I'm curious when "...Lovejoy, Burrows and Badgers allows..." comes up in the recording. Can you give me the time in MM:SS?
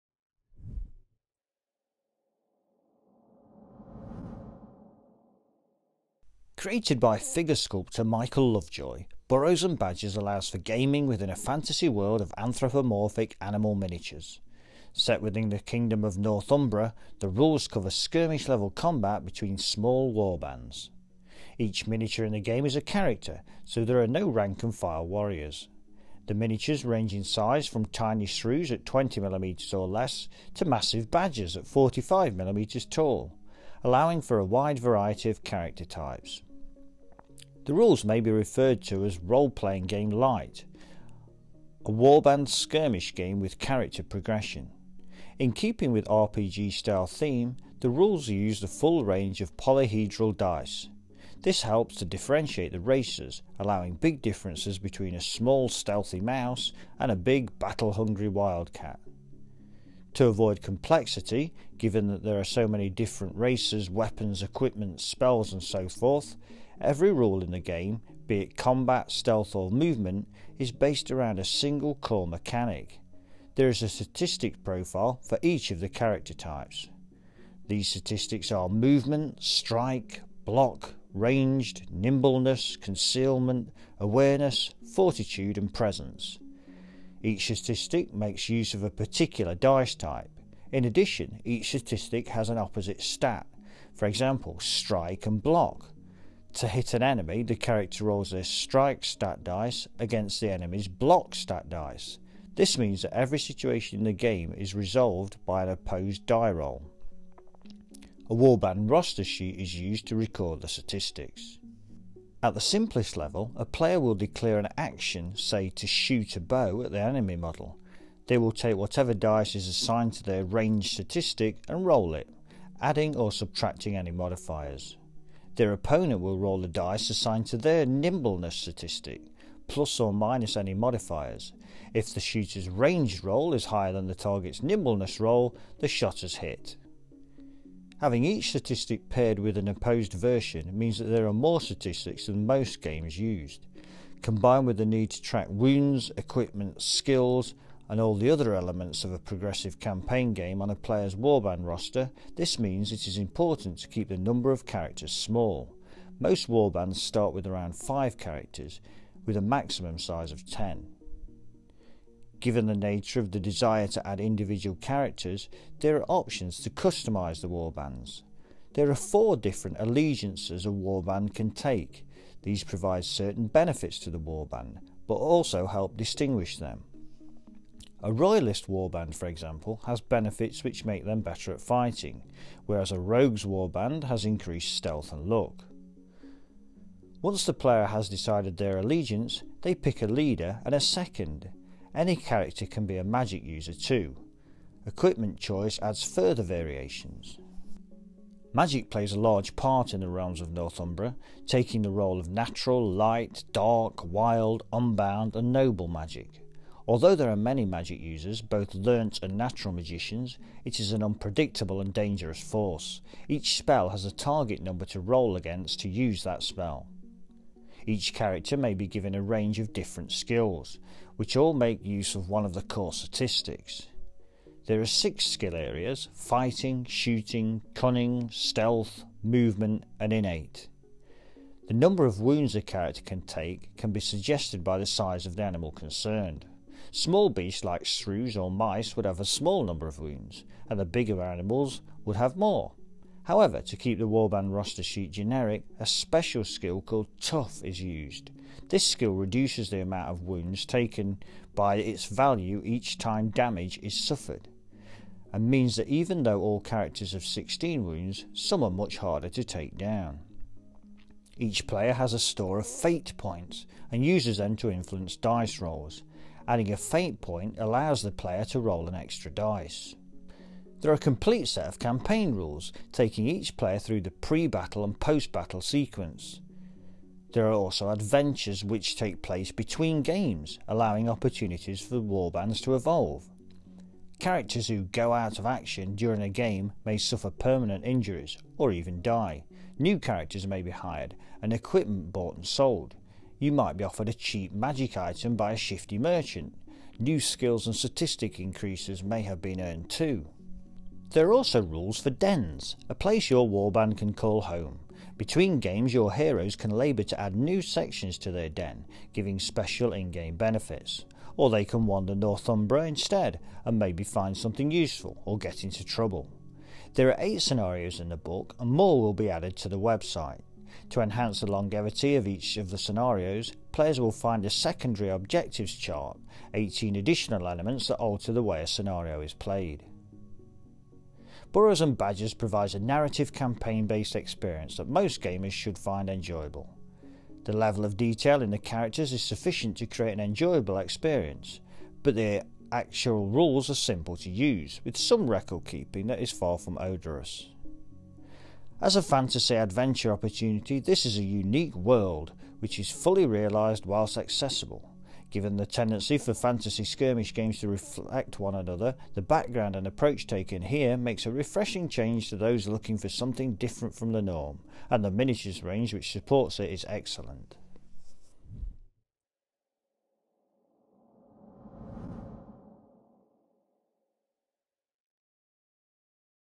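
00:08.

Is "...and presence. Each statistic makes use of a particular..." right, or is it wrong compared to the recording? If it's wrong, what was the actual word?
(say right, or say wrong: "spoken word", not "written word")
right.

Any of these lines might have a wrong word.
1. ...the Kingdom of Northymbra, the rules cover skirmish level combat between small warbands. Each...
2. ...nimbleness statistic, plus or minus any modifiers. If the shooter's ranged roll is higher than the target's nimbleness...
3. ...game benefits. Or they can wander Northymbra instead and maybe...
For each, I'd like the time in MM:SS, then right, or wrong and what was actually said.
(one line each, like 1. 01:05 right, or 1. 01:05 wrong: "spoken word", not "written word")
1. 00:15 right
2. 02:07 right
3. 05:10 right.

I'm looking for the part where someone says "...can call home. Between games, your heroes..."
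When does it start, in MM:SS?
05:03.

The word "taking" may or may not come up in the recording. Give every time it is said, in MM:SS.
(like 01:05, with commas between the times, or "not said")
03:21, 04:32.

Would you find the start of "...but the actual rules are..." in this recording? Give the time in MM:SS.
05:42.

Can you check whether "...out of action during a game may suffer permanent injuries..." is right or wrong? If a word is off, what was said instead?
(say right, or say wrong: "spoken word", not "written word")
right.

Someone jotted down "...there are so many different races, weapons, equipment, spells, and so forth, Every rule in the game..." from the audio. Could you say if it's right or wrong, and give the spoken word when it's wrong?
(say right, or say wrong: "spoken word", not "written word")
right.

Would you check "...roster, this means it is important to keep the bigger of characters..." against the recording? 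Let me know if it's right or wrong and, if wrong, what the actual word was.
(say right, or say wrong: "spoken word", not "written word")
wrong: "number", not "bigger".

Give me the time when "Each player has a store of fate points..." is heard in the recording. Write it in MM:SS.
04:21.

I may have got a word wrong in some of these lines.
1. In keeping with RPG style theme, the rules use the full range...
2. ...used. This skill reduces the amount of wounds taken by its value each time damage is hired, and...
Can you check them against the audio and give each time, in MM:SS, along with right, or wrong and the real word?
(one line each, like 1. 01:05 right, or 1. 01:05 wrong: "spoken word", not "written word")
1. 00:45 right
2. 04:07 wrong: "suffered", not "hired".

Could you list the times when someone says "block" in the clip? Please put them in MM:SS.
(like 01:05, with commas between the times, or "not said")
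01:20, 01:35, 01:40.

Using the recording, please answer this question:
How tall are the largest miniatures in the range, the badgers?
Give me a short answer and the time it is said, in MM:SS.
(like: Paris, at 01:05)
45mm, at 00:31.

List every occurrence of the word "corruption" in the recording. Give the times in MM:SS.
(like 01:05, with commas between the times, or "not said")
not said.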